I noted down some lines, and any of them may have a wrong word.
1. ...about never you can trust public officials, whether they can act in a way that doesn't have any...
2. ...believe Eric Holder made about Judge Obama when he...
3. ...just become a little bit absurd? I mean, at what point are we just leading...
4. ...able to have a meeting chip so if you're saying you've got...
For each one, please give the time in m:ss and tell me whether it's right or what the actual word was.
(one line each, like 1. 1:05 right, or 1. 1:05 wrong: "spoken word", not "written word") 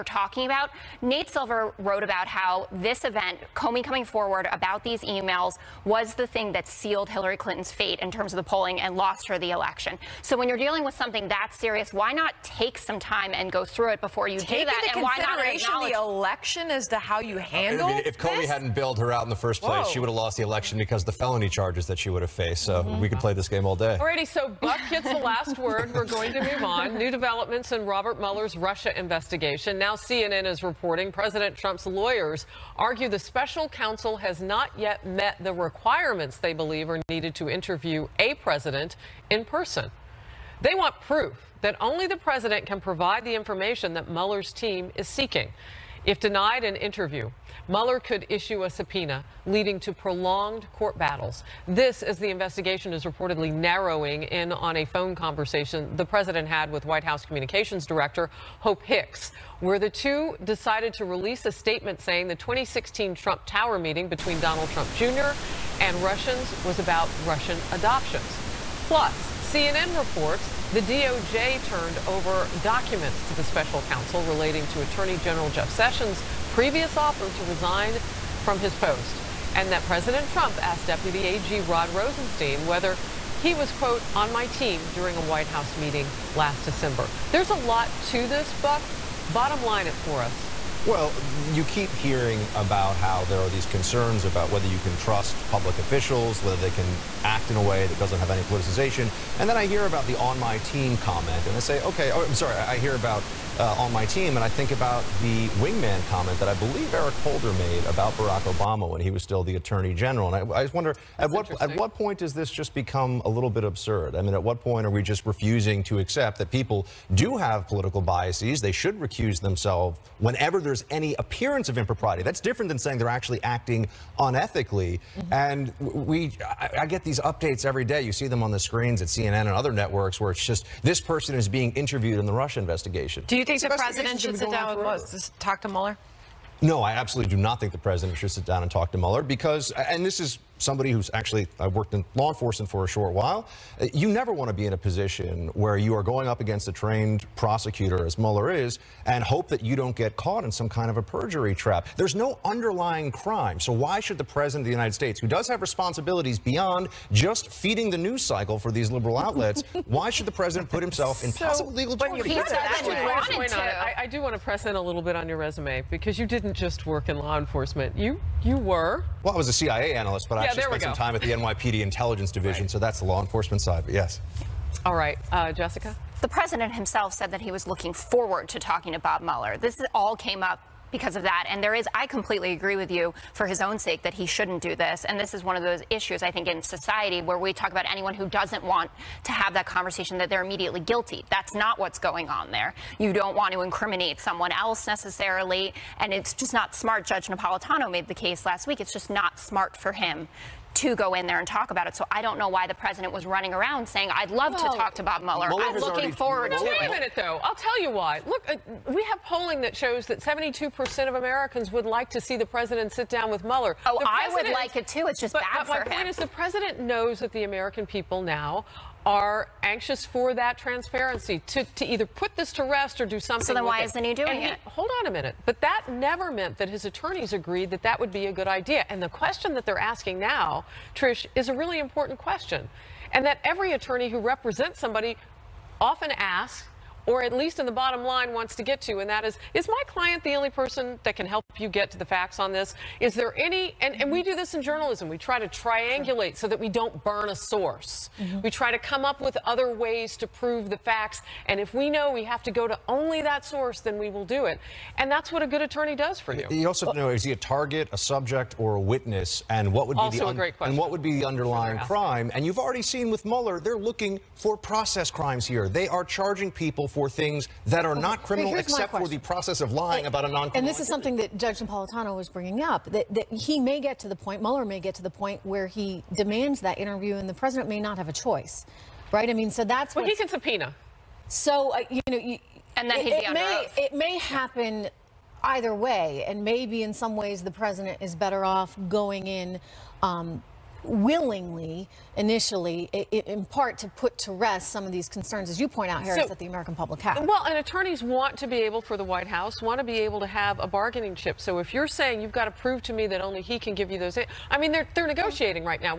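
1. 1:34 wrong: "whether", not "never"
2. 1:46 wrong: "Barack", not "Judge"
3. 1:52 wrong: "refusing", not "leading"
4. 4:59 wrong: "bargaining", not "meeting".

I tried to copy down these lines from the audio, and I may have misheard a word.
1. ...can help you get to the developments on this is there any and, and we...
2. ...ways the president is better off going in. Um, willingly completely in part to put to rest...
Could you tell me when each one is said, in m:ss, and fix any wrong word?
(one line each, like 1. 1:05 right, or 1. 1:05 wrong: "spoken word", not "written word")
1. 4:01 wrong: "facts", not "developments"
2. 4:47 wrong: "initially", not "completely".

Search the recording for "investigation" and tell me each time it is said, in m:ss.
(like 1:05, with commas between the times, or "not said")
0:28, 0:52, 2:12.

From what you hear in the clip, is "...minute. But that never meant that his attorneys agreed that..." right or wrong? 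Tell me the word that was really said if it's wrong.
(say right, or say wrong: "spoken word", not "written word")
right.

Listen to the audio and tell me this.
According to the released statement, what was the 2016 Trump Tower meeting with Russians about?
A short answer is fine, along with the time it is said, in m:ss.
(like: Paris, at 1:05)
Russian adoptions, at 1:07.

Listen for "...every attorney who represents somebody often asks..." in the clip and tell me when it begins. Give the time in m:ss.
3:53.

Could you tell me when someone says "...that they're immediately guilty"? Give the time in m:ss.
3:10.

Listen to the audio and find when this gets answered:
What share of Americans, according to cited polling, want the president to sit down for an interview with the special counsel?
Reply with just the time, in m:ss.
3:30.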